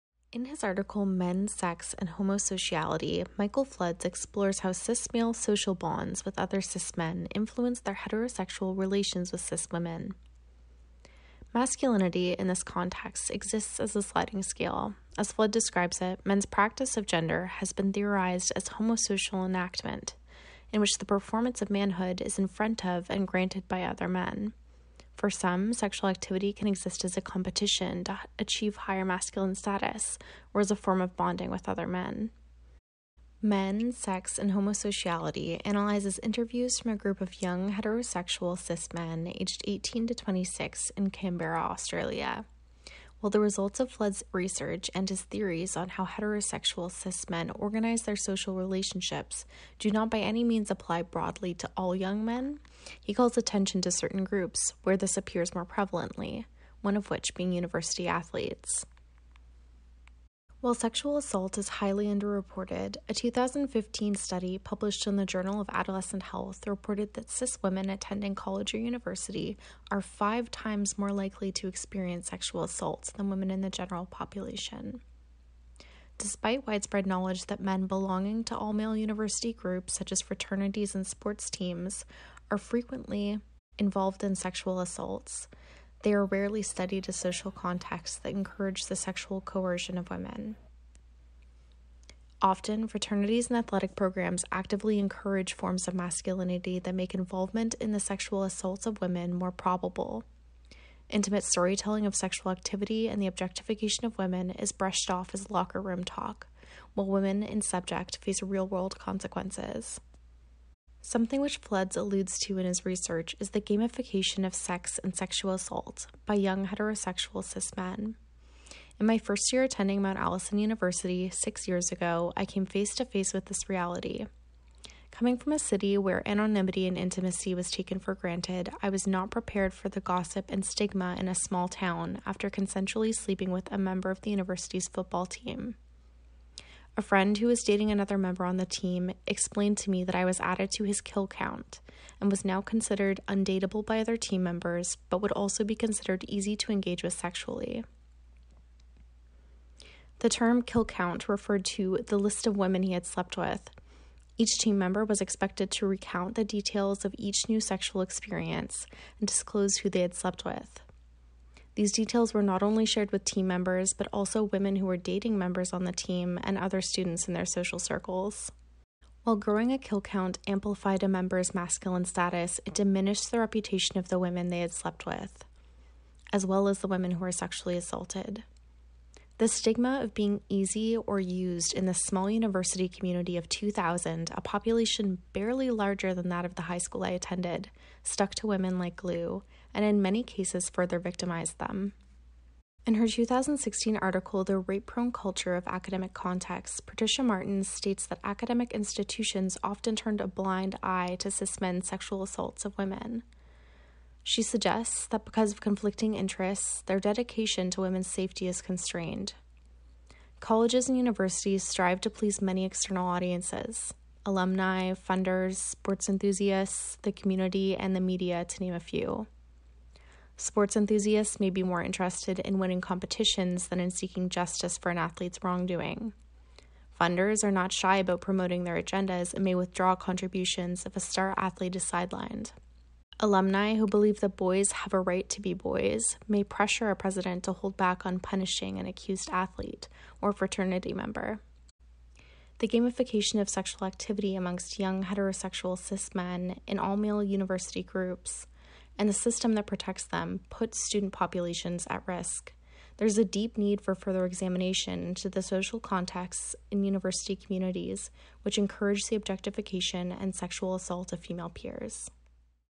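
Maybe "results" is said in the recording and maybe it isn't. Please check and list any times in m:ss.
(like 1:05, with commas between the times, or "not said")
0:43.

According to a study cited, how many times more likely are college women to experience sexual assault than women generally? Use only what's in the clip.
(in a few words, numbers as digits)
5.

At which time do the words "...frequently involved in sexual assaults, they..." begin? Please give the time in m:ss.
1:22.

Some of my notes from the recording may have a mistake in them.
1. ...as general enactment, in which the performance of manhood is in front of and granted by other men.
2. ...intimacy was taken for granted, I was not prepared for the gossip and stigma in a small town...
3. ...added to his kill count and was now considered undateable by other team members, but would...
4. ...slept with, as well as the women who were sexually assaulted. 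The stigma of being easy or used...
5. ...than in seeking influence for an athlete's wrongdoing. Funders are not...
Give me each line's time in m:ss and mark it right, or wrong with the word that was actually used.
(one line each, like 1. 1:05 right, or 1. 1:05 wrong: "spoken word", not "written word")
1. 0:18 wrong: "homosocial", not "general"
2. 2:06 right
3. 2:20 right
4. 2:54 right
5. 3:43 wrong: "justice", not "influence".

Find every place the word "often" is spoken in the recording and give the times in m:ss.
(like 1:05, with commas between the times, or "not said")
1:32, 3:19.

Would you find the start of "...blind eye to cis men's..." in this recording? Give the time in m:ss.
3:20.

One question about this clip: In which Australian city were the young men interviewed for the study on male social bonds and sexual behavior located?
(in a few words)
Canberra.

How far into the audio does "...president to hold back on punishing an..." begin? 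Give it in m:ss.
3:56.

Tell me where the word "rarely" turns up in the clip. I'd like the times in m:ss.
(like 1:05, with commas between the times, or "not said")
1:26.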